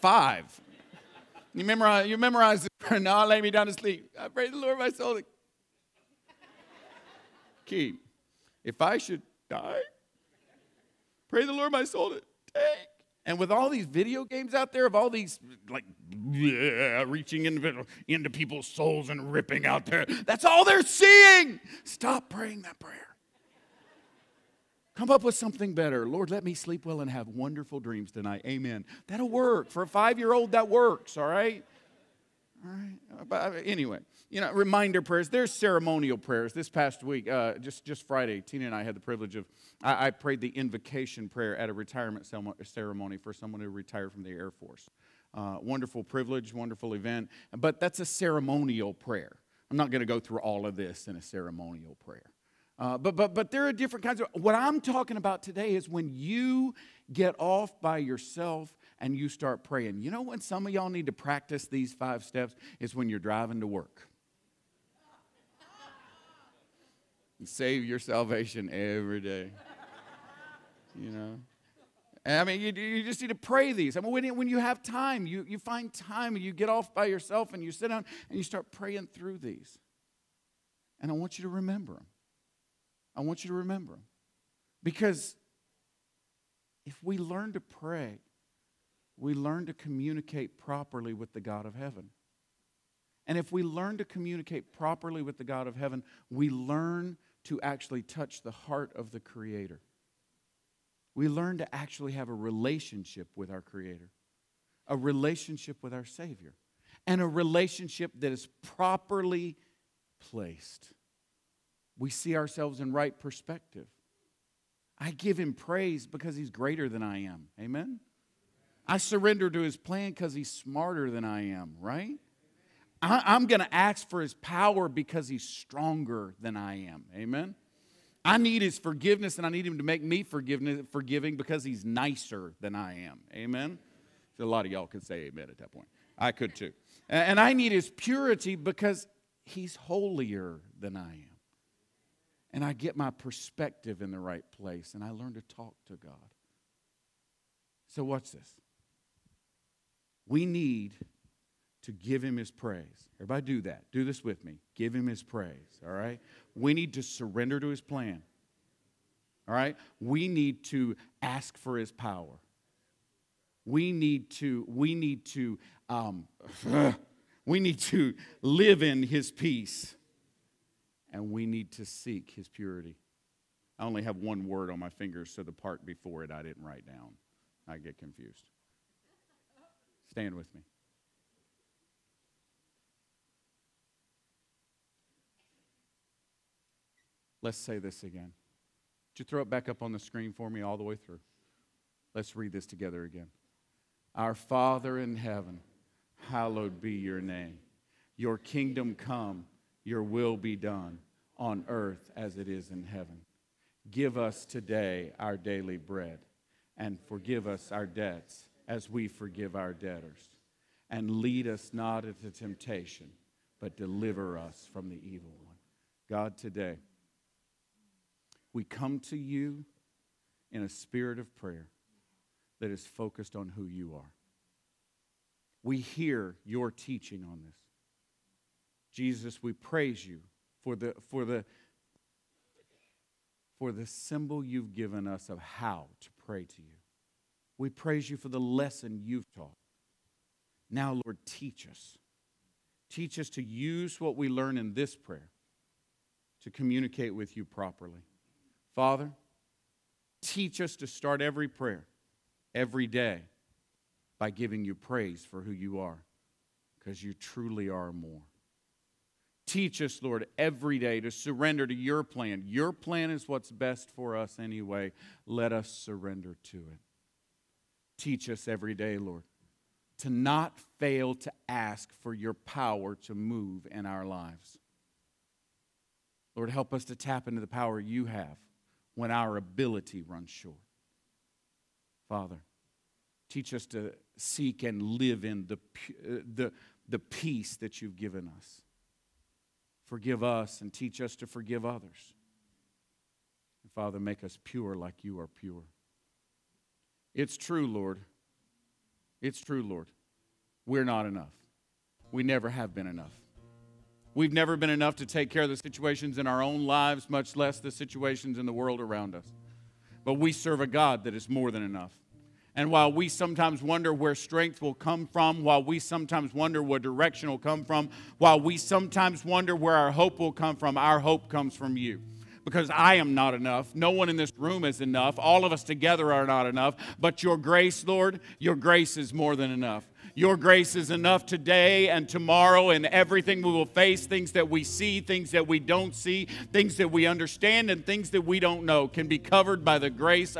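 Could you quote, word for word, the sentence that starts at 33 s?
But uh, anyway, you know, reminder prayers.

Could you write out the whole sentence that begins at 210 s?
And lead us not into temptation, but deliver us from the evil one.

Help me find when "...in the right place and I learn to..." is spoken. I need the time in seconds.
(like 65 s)
144 s.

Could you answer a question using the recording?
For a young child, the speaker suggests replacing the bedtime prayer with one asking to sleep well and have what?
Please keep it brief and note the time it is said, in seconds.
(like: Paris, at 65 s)
wonderful dreams, at 27 s.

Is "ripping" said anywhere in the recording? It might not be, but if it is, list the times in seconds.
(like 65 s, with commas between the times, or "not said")
19 s.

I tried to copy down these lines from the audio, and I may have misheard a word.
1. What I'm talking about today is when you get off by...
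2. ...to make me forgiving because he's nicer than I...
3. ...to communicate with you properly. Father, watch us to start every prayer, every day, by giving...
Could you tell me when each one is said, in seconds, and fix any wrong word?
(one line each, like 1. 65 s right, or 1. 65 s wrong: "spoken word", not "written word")
1. 54 s right
2. 129 s right
3. 246 s wrong: "teach", not "watch".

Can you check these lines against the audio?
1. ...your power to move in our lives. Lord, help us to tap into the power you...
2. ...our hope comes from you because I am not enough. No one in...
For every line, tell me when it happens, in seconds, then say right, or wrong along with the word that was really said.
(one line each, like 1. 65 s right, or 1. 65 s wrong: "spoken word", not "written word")
1. 272 s right
2. 320 s right.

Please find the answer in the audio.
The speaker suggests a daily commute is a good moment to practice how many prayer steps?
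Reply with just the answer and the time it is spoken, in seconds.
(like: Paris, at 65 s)
5, at 61 s.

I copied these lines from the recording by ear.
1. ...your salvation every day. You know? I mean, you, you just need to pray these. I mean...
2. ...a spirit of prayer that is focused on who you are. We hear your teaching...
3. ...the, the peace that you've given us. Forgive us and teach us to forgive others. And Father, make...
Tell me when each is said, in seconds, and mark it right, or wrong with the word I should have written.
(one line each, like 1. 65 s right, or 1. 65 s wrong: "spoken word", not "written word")
1. 67 s right
2. 220 s right
3. 286 s right.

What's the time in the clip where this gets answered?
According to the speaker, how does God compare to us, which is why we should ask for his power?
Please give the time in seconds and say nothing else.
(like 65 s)
125 s.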